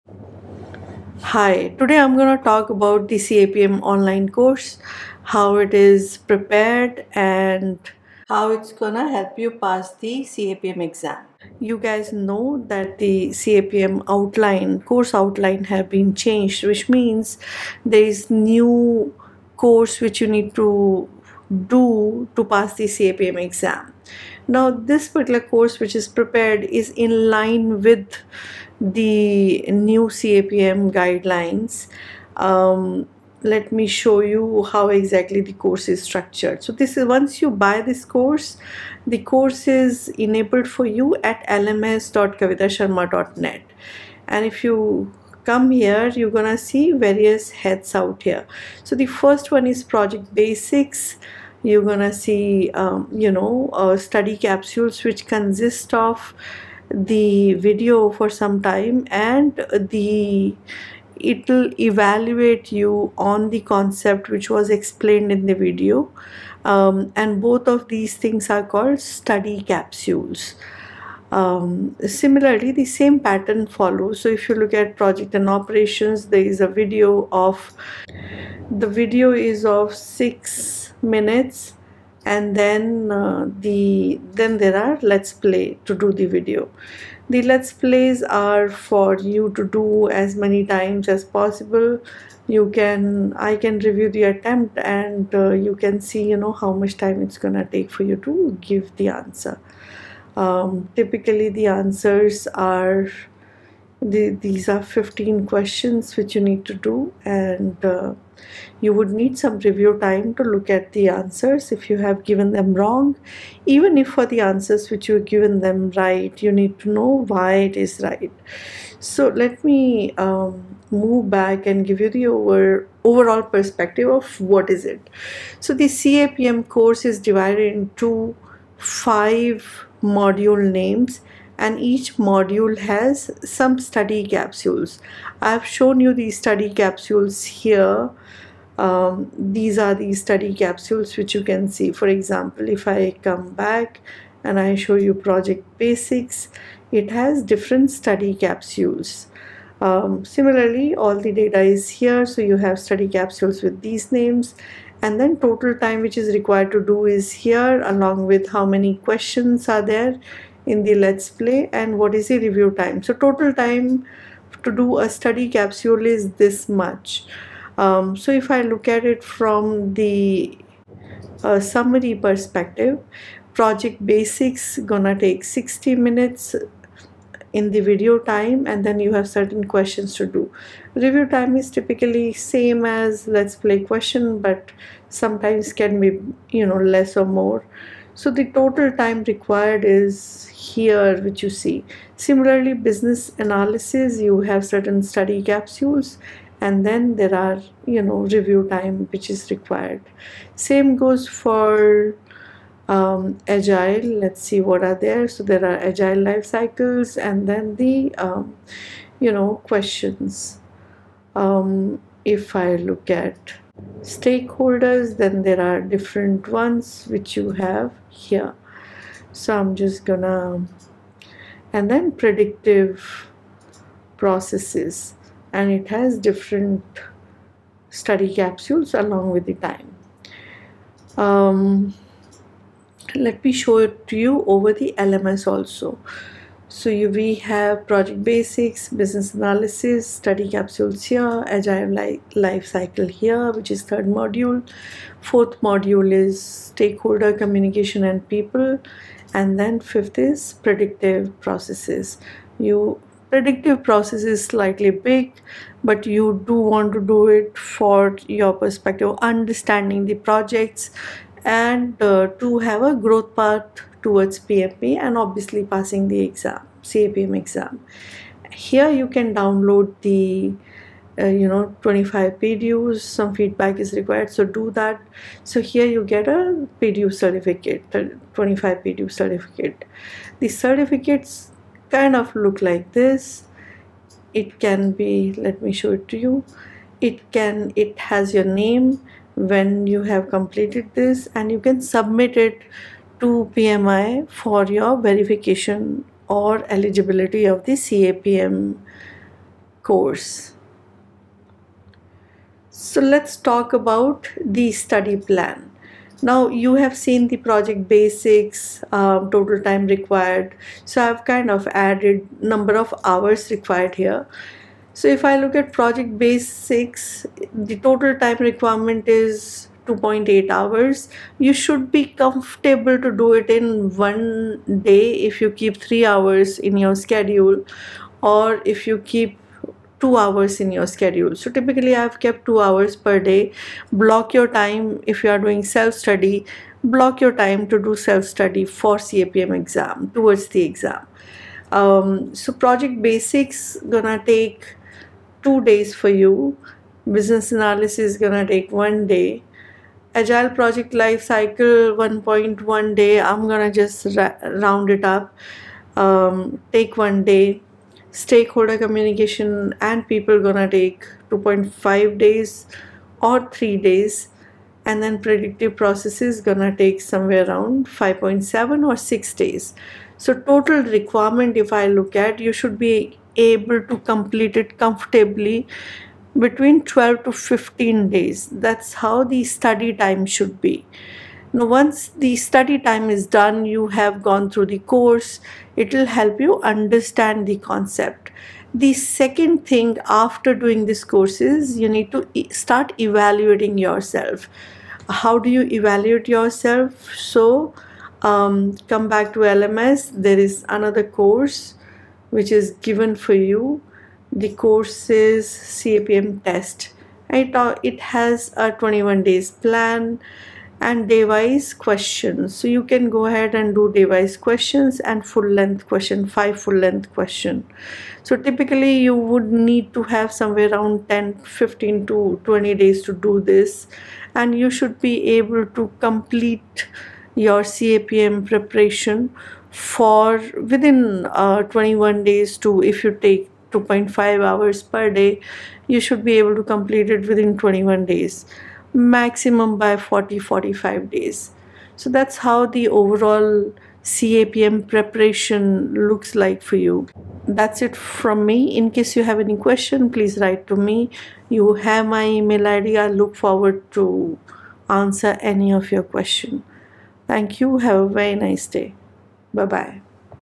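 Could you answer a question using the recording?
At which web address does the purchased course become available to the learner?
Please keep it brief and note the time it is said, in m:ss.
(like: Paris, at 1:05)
lms.kavitasharma.net, at 0:41.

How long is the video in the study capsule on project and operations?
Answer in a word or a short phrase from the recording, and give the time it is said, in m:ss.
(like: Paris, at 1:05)
6 minutes, at 1:19.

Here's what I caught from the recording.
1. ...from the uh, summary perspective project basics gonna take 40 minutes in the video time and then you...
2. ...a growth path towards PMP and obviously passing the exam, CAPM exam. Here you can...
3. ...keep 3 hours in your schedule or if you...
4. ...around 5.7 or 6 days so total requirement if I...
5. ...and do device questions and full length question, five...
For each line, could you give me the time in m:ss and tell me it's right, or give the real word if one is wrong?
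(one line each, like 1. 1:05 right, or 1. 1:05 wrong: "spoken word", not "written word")
1. 2:49 wrong: "60", not "40"
2. 4:22 right
3. 5:25 right
4. 6:07 right
5. 6:53 right.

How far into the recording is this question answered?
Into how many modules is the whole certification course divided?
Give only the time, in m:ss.
2:08.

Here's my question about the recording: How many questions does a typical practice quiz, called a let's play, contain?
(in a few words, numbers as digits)
15.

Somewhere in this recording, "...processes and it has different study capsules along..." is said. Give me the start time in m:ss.
3:44.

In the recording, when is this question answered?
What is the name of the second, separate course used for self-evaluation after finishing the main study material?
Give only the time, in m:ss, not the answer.
6:45.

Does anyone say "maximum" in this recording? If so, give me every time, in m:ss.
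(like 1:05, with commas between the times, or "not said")
7:18.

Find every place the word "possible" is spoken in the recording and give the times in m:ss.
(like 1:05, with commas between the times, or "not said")
1:31.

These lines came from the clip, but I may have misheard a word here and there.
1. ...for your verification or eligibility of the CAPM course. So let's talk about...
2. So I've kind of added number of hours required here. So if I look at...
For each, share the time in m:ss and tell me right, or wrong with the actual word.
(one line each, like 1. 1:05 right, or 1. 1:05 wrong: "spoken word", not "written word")
1. 4:54 right
2. 5:10 right.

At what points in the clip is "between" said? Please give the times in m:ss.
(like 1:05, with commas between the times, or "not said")
6:16.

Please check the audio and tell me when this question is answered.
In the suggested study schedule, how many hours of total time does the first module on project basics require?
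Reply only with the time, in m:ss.
5:19.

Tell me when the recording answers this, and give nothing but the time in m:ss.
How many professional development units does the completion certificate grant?
4:38.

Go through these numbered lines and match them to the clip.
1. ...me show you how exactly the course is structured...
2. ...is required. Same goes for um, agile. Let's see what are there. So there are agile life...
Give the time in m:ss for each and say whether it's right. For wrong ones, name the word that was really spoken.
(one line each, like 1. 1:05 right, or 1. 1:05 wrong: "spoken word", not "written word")
1. 0:33 right
2. 3:19 right.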